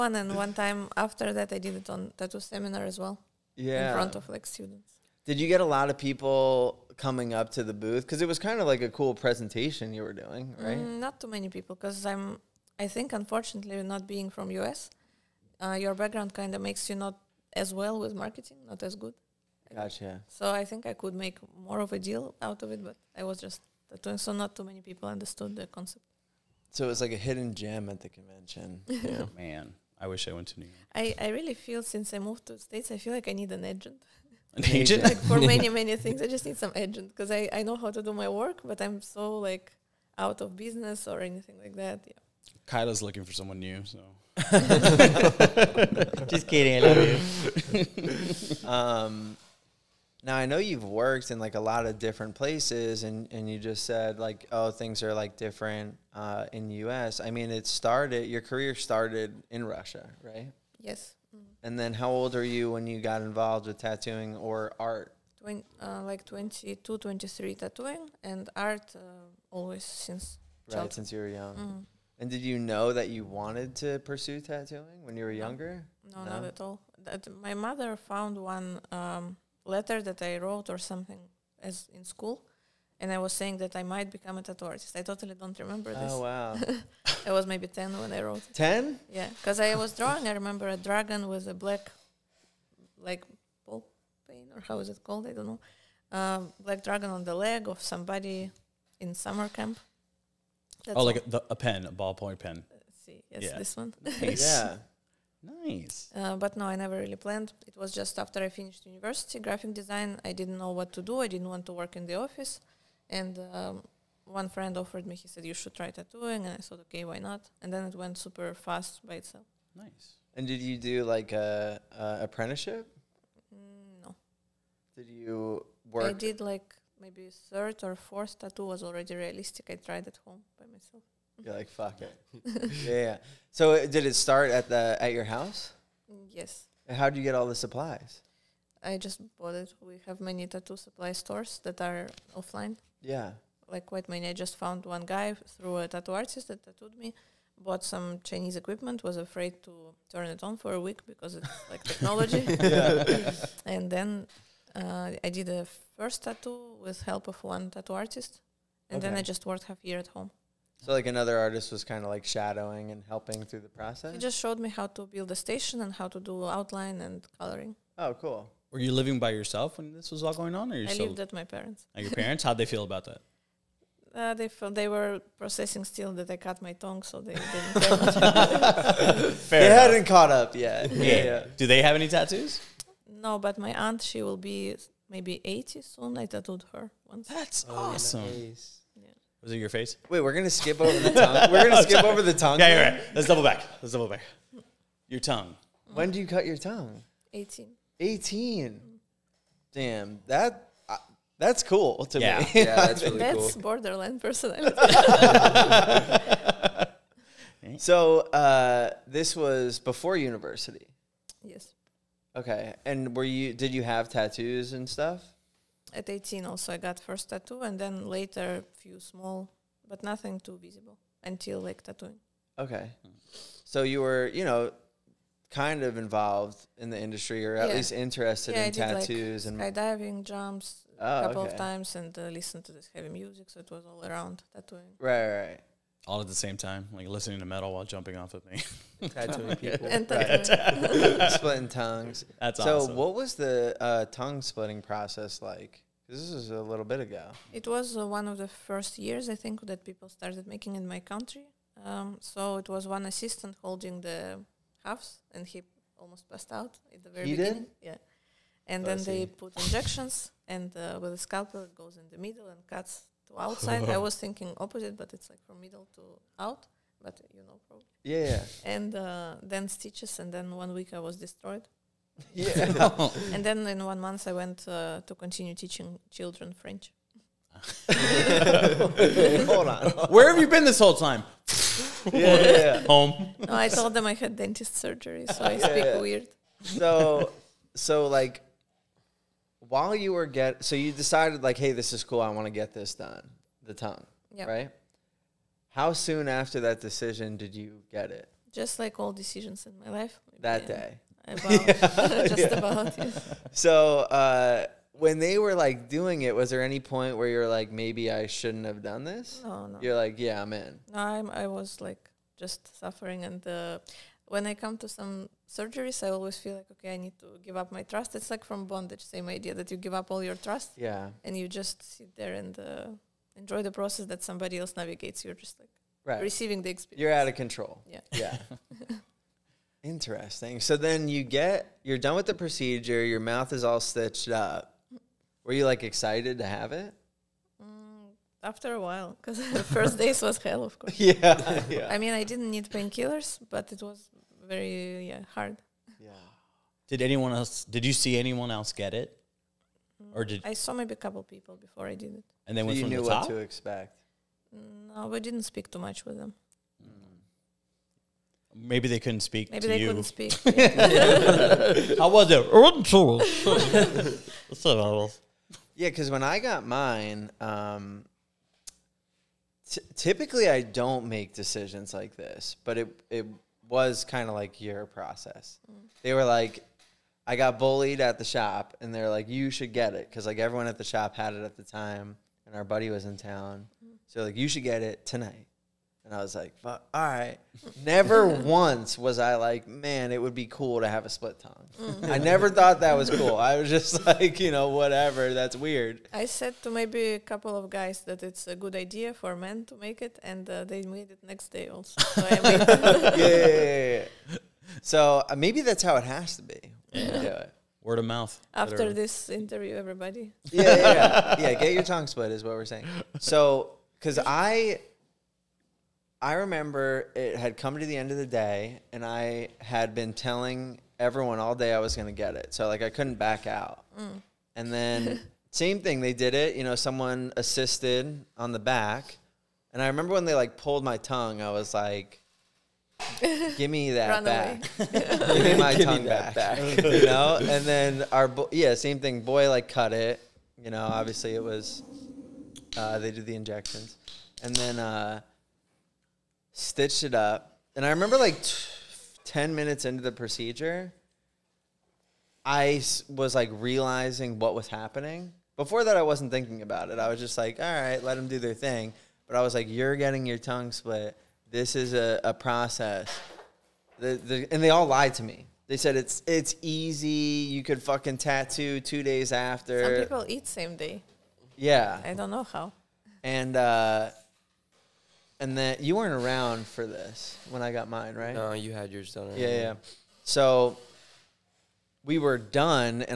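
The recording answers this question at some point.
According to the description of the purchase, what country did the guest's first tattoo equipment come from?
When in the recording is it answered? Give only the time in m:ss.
2:28.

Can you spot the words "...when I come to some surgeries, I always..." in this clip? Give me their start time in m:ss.
5:14.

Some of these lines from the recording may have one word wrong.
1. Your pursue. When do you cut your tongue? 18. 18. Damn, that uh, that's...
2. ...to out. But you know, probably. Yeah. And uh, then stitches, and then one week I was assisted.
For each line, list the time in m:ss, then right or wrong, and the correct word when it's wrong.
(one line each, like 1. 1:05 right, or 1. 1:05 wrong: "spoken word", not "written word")
1. 3:15 wrong: "tongue", not "pursue"
2. 4:25 wrong: "destroyed", not "assisted".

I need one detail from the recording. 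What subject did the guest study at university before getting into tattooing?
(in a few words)
graphic design.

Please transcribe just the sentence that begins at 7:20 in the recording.
You know, obviously it was, uh, they did the injections.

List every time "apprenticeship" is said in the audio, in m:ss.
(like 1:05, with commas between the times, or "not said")
2:02.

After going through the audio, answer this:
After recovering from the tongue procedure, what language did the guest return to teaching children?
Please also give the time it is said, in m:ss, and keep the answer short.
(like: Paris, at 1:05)
French, at 4:36.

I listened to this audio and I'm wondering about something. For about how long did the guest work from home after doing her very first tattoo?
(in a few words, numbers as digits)
half year.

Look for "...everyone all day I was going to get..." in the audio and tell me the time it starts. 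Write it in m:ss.
7:00.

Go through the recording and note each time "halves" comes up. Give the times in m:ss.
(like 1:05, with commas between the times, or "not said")
4:14.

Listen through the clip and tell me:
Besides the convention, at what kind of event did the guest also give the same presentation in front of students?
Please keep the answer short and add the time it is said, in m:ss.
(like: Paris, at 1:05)
tattoo seminar, at 0:02.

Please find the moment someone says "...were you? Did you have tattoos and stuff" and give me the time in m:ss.
3:33.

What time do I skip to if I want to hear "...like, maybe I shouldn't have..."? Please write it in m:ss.
5:07.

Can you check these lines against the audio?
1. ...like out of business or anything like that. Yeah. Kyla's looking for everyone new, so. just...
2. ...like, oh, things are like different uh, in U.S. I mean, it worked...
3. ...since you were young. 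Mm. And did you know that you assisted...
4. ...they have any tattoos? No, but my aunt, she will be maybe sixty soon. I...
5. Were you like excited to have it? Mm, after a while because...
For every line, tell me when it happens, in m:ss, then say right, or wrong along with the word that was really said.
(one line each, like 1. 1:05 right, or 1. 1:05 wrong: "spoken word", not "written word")
1. 0:39 wrong: "someone", not "everyone"
2. 0:54 wrong: "started", not "worked"
3. 1:10 wrong: "wanted", not "assisted"
4. 3:01 wrong: "eighty", not "sixty"
5. 5:35 right.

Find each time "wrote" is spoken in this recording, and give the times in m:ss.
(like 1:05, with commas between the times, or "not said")
1:20, 1:28.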